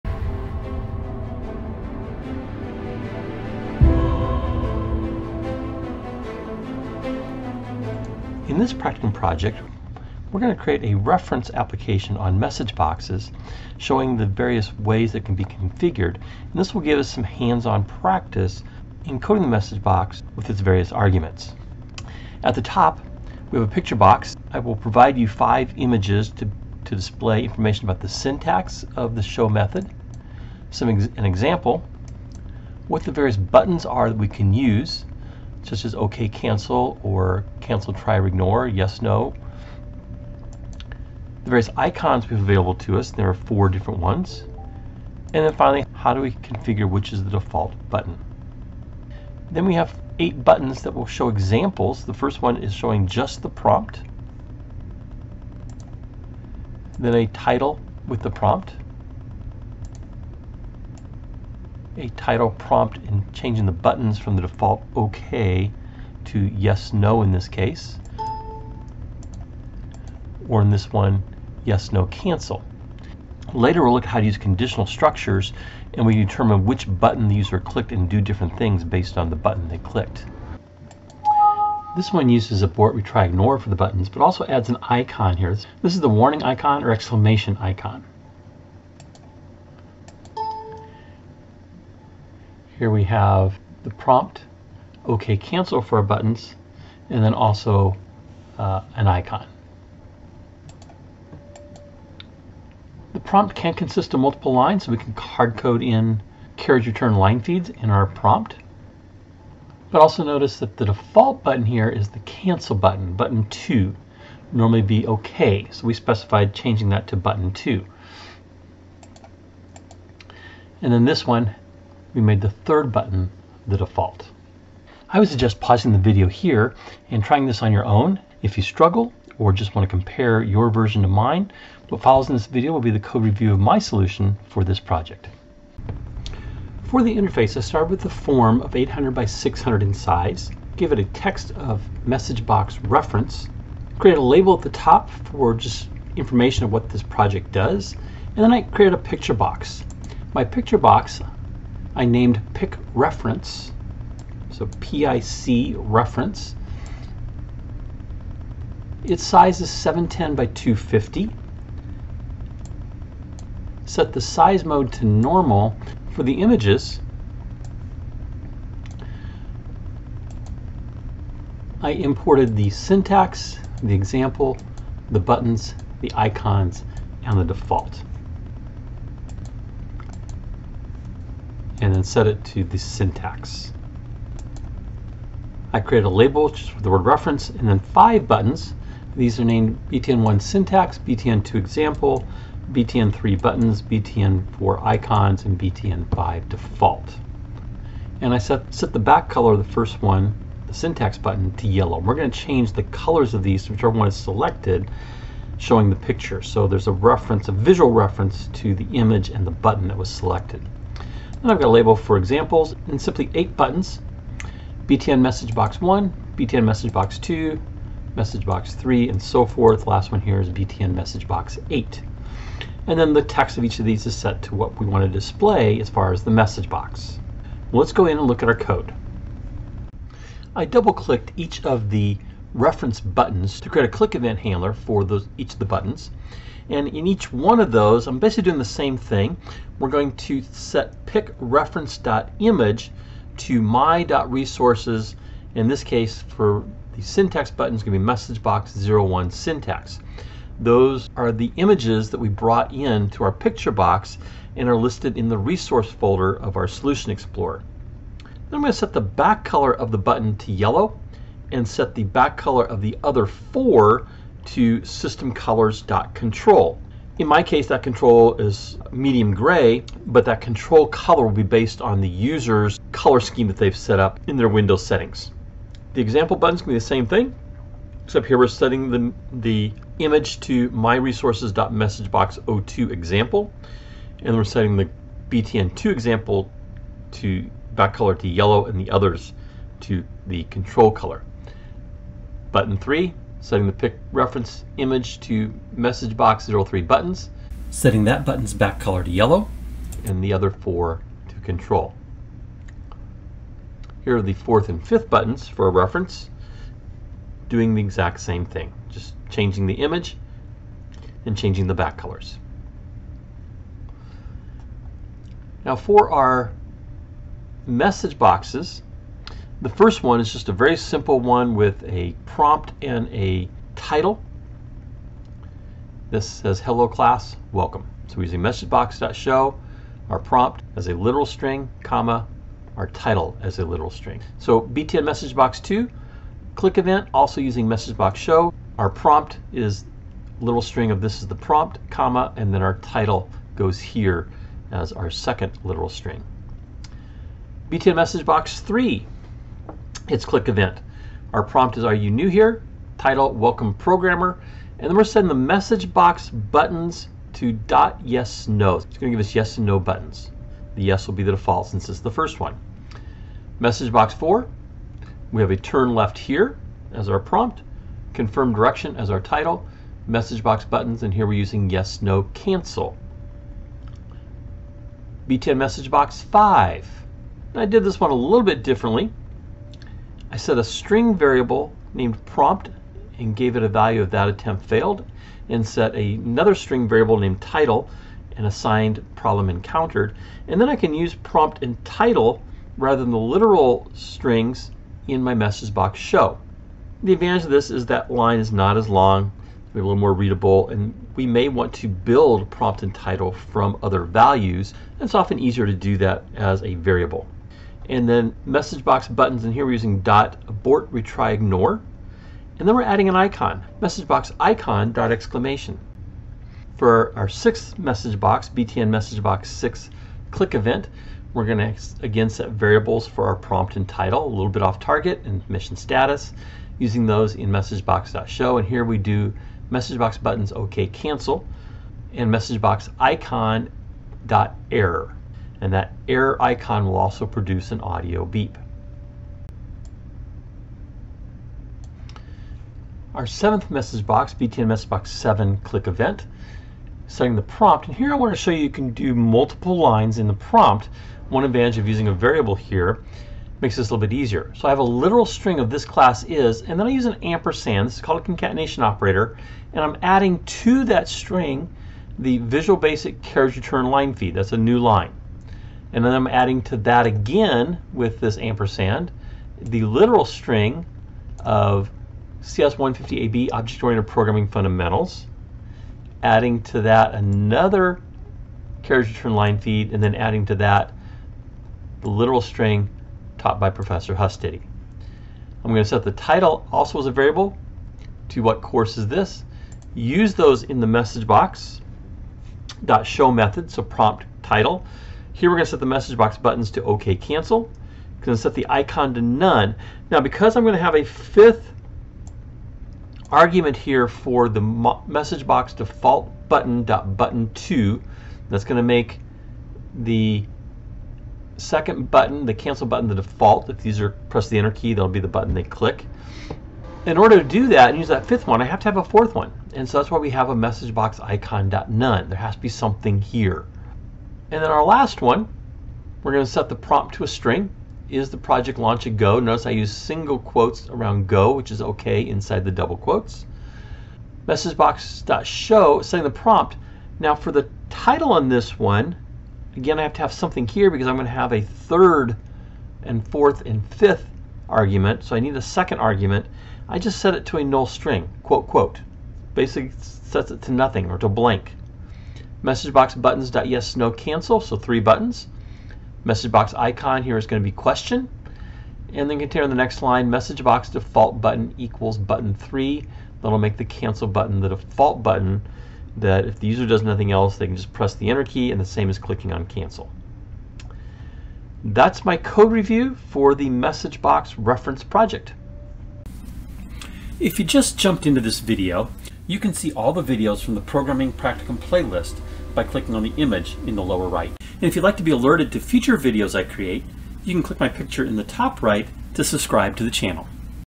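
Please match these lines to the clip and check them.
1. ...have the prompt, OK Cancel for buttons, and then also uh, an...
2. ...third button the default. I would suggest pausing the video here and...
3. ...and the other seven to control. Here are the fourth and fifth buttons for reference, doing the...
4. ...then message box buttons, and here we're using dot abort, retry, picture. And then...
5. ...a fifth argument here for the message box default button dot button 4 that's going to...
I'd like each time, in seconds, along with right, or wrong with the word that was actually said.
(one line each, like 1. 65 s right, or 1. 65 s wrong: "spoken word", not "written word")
1. 93 s right
2. 122 s right
3. 300 s wrong: "four", not "seven"
4. 408 s wrong: "ignore", not "picture"
5. 500 s wrong: "2", not "4".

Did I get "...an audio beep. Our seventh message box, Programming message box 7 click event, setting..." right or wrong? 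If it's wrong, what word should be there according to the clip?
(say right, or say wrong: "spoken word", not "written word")
wrong: "BTN", not "Programming".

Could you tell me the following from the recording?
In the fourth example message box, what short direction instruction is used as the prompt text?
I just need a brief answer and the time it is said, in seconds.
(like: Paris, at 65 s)
Turn left, at 365 s.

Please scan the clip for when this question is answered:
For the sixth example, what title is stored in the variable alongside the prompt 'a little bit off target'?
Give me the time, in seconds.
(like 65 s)
425 s.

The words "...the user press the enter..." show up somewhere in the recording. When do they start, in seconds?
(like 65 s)
513 s.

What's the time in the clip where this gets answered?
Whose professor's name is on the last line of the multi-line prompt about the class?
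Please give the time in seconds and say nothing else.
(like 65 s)
484 s.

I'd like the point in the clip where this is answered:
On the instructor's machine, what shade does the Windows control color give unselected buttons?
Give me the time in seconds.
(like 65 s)
268 s.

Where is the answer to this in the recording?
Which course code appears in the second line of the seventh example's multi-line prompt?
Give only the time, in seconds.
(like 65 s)
472 s.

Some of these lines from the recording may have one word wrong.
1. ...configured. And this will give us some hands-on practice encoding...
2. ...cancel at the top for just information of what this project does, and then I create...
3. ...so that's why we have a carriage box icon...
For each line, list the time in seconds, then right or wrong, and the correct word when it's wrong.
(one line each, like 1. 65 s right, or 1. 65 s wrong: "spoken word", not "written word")
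1. 15 s right
2. 144 s wrong: "label", not "cancel"
3. 519 s wrong: "message", not "carriage".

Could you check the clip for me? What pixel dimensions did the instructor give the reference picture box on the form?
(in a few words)
710 by 250.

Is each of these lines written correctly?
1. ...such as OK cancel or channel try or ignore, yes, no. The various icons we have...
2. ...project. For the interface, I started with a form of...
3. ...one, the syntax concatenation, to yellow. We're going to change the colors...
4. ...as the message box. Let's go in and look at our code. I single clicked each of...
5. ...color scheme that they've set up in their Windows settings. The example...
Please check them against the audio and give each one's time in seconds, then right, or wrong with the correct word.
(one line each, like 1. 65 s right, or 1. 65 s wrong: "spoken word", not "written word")
1. 35 s wrong: "cancel", not "channel"
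2. 134 s right
3. 200 s wrong: "button", not "concatenation"
4. 226 s wrong: "double", not "single"
5. 272 s right.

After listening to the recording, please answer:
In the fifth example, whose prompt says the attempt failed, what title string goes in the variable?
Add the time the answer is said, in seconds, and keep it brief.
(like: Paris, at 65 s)
Problem encountered, at 389 s.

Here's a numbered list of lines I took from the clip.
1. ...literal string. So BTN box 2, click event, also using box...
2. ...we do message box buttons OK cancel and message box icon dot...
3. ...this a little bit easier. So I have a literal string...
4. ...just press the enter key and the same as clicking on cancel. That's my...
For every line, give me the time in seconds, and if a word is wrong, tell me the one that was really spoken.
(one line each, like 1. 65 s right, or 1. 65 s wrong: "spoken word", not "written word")
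1. 333 s right
2. 428 s right
3. 453 s right
4. 567 s right.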